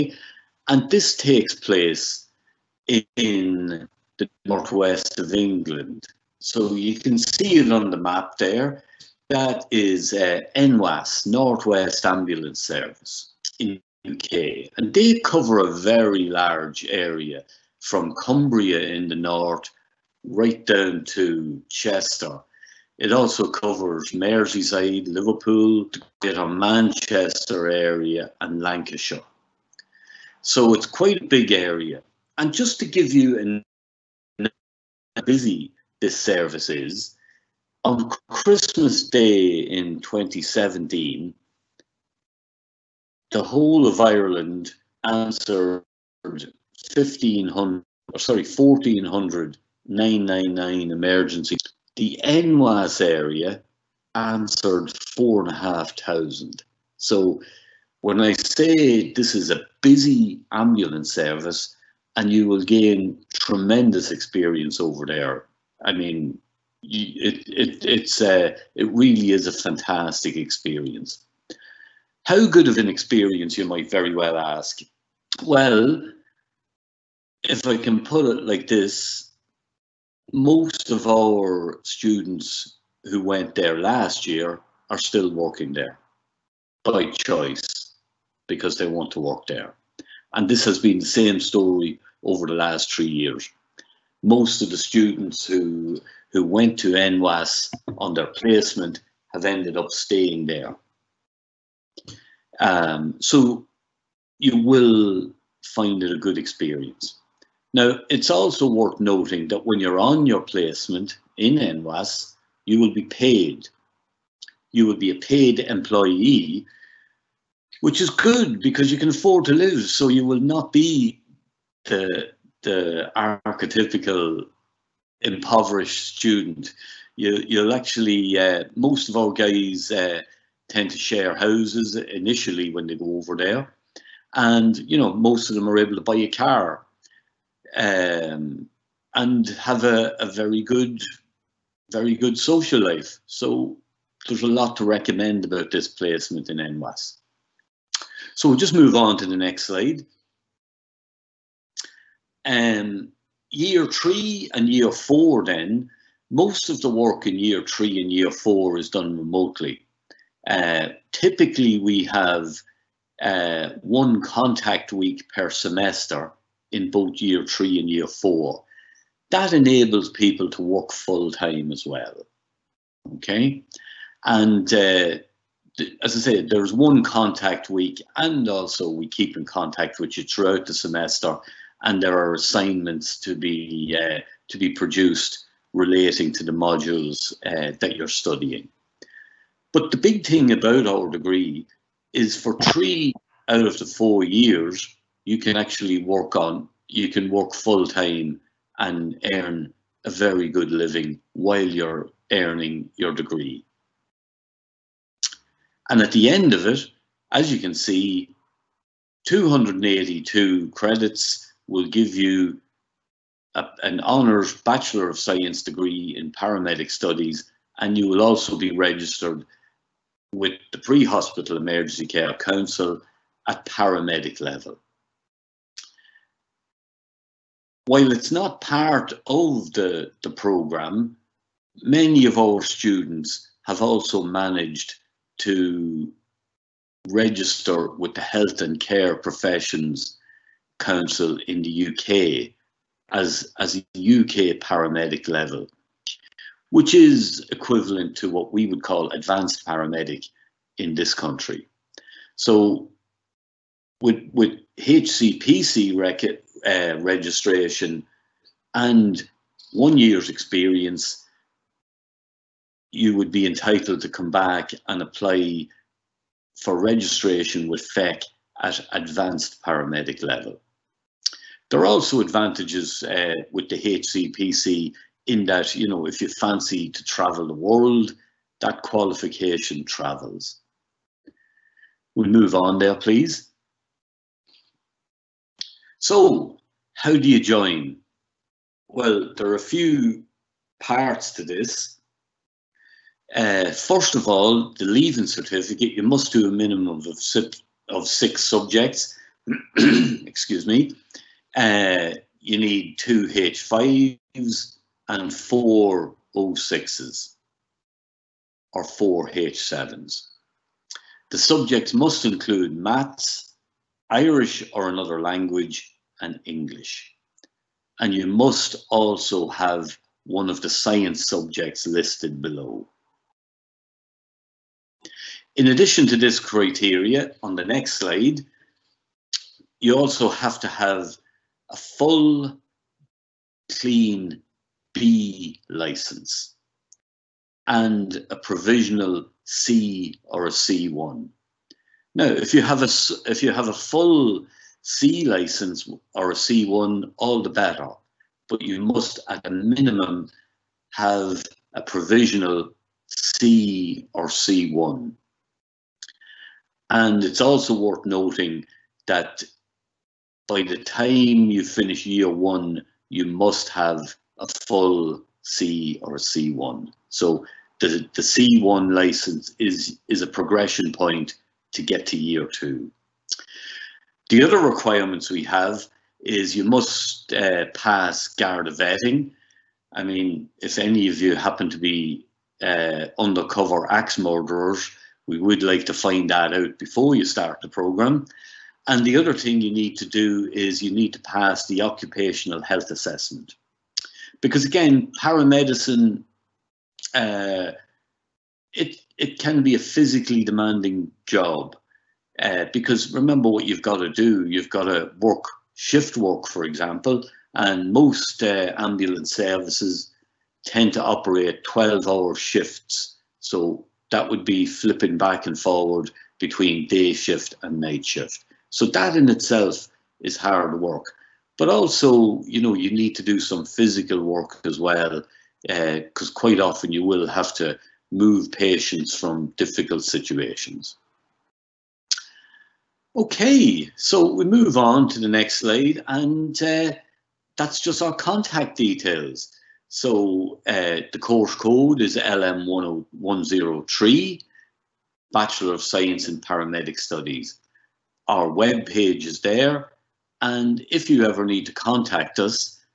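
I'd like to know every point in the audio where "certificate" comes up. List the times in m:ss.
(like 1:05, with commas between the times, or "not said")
4:55.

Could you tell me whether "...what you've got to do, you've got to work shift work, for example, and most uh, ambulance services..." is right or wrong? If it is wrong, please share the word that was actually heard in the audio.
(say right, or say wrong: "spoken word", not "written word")
right.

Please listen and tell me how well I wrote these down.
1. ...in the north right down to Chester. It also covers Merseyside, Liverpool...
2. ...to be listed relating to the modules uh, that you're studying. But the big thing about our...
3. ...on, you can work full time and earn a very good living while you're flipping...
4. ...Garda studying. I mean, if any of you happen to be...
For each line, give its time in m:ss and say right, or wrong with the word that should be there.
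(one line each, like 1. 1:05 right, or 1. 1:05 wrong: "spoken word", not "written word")
1. 0:18 right
2. 3:04 wrong: "produced", not "listed"
3. 3:16 wrong: "earning", not "flipping"
4. 6:18 wrong: "vetting", not "studying".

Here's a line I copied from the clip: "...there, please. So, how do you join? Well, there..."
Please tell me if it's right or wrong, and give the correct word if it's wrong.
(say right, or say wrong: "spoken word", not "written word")
right.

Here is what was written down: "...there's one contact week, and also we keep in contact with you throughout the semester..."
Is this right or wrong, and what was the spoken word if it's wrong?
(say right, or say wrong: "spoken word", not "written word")
right.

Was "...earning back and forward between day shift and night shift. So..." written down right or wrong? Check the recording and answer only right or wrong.
wrong.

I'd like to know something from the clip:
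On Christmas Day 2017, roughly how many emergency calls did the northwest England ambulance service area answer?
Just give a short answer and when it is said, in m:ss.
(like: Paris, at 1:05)
4500, at 0:55.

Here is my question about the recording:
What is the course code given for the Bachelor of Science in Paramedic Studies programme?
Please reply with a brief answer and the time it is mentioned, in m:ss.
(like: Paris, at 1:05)
LM103, at 7:22.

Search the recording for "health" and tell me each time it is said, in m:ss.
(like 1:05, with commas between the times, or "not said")
3:58, 6:32.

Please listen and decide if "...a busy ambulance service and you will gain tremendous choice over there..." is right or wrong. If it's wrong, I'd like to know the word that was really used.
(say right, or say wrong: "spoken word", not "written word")
wrong: "experience", not "choice".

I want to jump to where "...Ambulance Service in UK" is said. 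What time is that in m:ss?
0:12.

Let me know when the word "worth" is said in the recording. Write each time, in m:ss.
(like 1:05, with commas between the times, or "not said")
1:48, 5:57.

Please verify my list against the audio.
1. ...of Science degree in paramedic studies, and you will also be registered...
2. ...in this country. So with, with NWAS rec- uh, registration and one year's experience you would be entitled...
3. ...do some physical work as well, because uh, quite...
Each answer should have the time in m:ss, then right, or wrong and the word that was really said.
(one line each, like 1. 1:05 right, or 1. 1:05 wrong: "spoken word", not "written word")
1. 3:35 right
2. 4:10 wrong: "HCPC", not "NWAS"
3. 7:03 right.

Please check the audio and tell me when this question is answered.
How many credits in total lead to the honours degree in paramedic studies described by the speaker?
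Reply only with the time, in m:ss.
3:29.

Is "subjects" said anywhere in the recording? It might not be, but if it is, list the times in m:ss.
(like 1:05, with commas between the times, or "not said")
4:58, 5:11, 5:21.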